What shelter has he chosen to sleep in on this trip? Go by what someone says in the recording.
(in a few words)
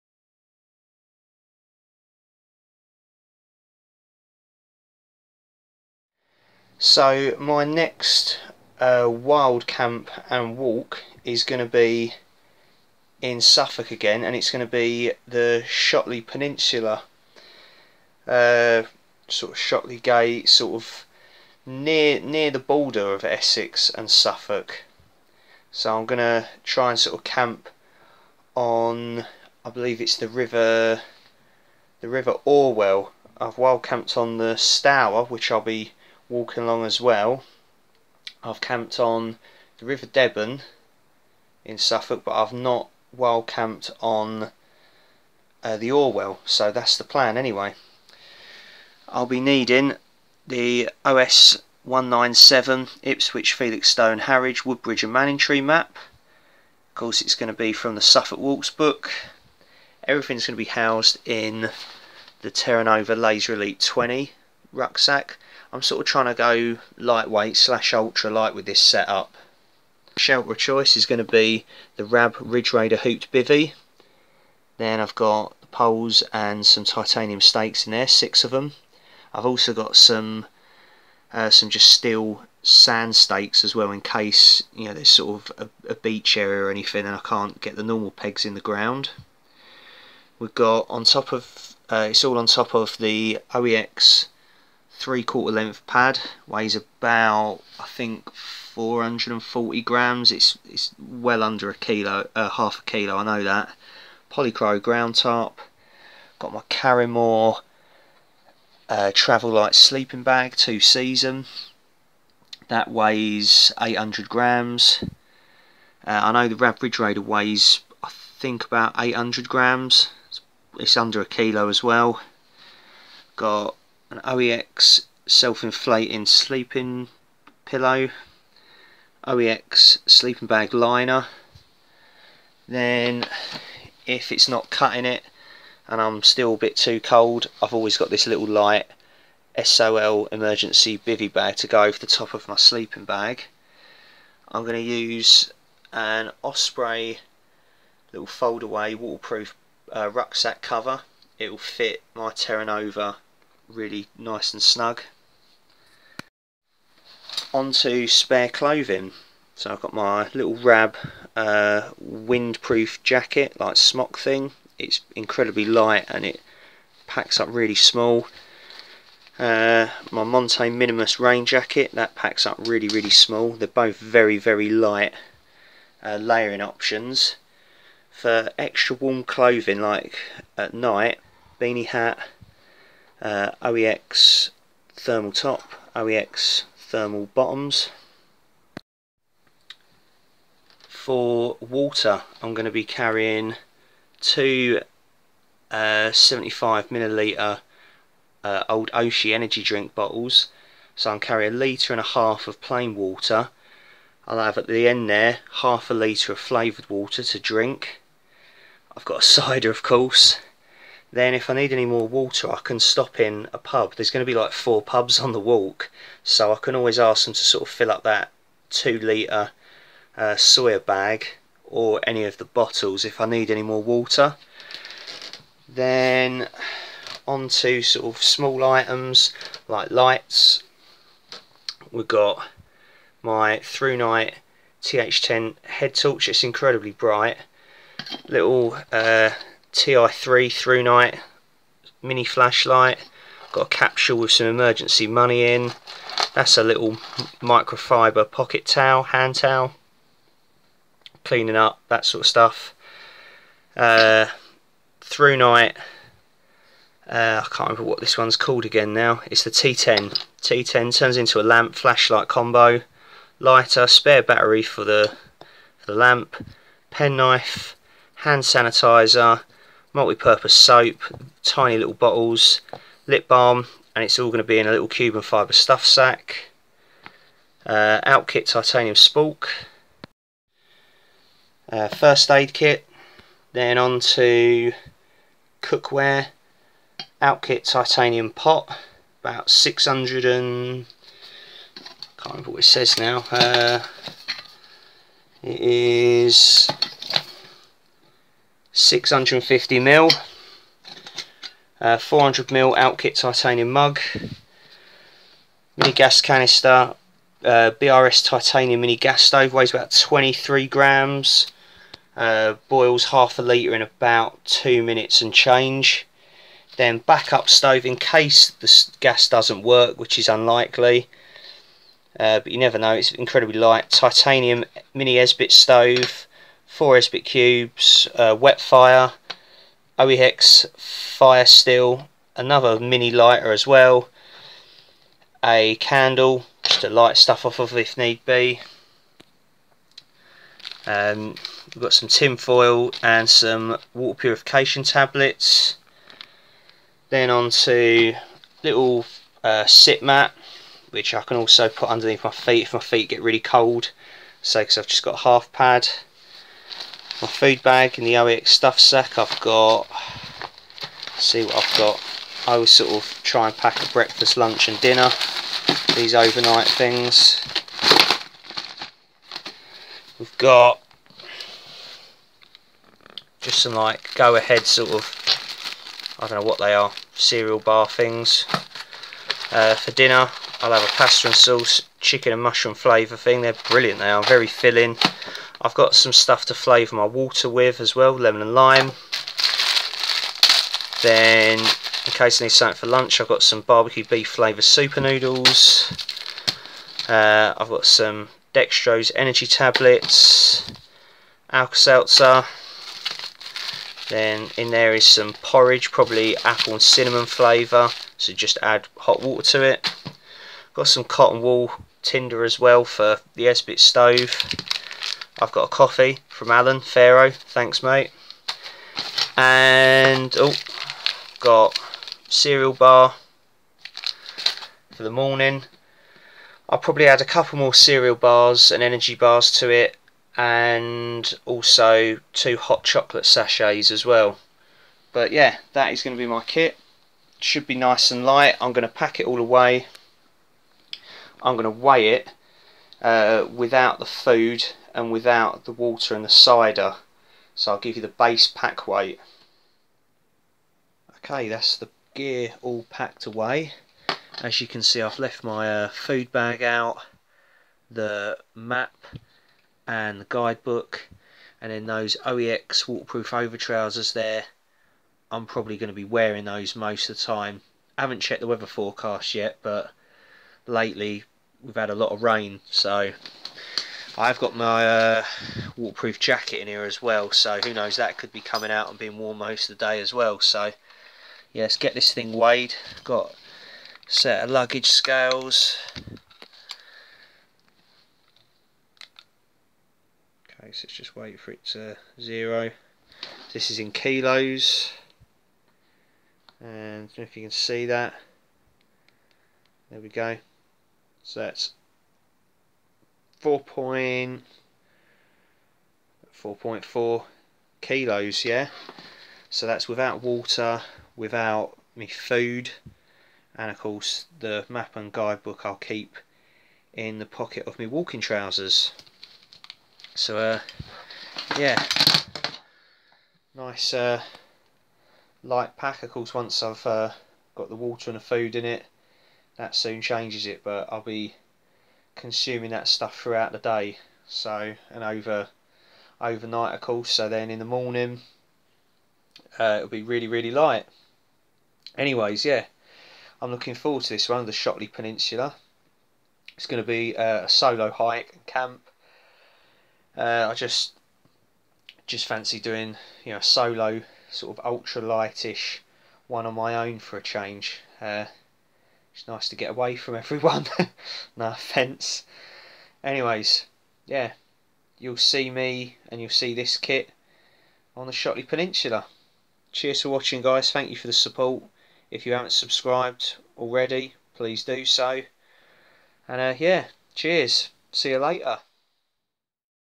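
Rab Ridge Raider Hooped Bivy.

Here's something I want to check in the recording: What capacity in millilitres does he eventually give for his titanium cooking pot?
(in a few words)
650 ml.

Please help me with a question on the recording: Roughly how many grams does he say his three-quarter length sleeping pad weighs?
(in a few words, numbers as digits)
440 grams.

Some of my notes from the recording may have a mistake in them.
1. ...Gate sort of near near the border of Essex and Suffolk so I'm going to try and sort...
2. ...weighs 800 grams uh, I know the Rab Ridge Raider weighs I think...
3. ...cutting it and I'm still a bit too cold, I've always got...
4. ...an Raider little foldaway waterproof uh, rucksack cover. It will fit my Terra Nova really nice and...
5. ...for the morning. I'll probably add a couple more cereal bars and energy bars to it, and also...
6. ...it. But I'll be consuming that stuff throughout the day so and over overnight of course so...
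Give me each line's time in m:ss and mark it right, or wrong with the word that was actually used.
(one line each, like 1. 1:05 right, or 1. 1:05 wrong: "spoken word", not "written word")
1. 0:20 right
2. 1:52 right
3. 2:14 right
4. 2:25 wrong: "Osprey", not "Raider"
5. 7:04 right
6. 8:50 right.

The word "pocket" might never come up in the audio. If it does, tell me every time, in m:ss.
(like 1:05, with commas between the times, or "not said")
4:08, 8:37.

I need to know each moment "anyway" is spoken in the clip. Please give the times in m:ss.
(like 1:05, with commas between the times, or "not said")
0:47, 9:01, 9:23.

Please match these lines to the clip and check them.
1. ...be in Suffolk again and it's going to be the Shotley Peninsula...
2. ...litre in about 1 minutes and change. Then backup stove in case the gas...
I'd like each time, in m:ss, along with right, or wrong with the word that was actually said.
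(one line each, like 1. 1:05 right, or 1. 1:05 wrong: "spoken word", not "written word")
1. 0:11 right
2. 5:13 wrong: "2", not "1".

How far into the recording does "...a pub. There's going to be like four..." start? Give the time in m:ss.
3:33.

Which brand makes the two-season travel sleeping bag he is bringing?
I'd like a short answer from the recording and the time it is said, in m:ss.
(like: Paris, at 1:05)
Karrimor, at 1:46.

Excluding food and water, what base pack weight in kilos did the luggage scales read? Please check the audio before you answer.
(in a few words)
4.4 kilos.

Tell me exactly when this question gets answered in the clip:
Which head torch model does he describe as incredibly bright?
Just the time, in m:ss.
3:53.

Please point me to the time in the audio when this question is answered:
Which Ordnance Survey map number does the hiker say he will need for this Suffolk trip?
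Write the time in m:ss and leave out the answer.
0:51.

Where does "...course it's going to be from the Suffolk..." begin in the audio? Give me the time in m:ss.
0:56.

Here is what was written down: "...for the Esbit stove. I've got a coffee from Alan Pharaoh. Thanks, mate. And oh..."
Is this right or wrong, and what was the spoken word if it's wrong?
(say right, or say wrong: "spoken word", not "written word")
right.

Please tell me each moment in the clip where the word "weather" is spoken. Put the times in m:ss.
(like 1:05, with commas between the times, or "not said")
7:48.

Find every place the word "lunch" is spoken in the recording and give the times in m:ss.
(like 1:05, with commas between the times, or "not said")
6:04, 6:32.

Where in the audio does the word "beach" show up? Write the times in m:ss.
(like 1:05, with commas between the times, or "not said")
1:25.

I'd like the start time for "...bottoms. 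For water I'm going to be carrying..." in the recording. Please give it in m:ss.
3:07.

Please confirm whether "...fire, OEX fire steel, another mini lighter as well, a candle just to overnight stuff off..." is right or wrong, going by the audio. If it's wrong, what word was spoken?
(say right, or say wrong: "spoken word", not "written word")
wrong: "light", not "overnight".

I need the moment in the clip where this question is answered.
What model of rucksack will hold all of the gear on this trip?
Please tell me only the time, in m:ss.
1:02.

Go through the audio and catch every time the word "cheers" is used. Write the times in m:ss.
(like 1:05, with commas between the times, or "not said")
9:29, 9:37.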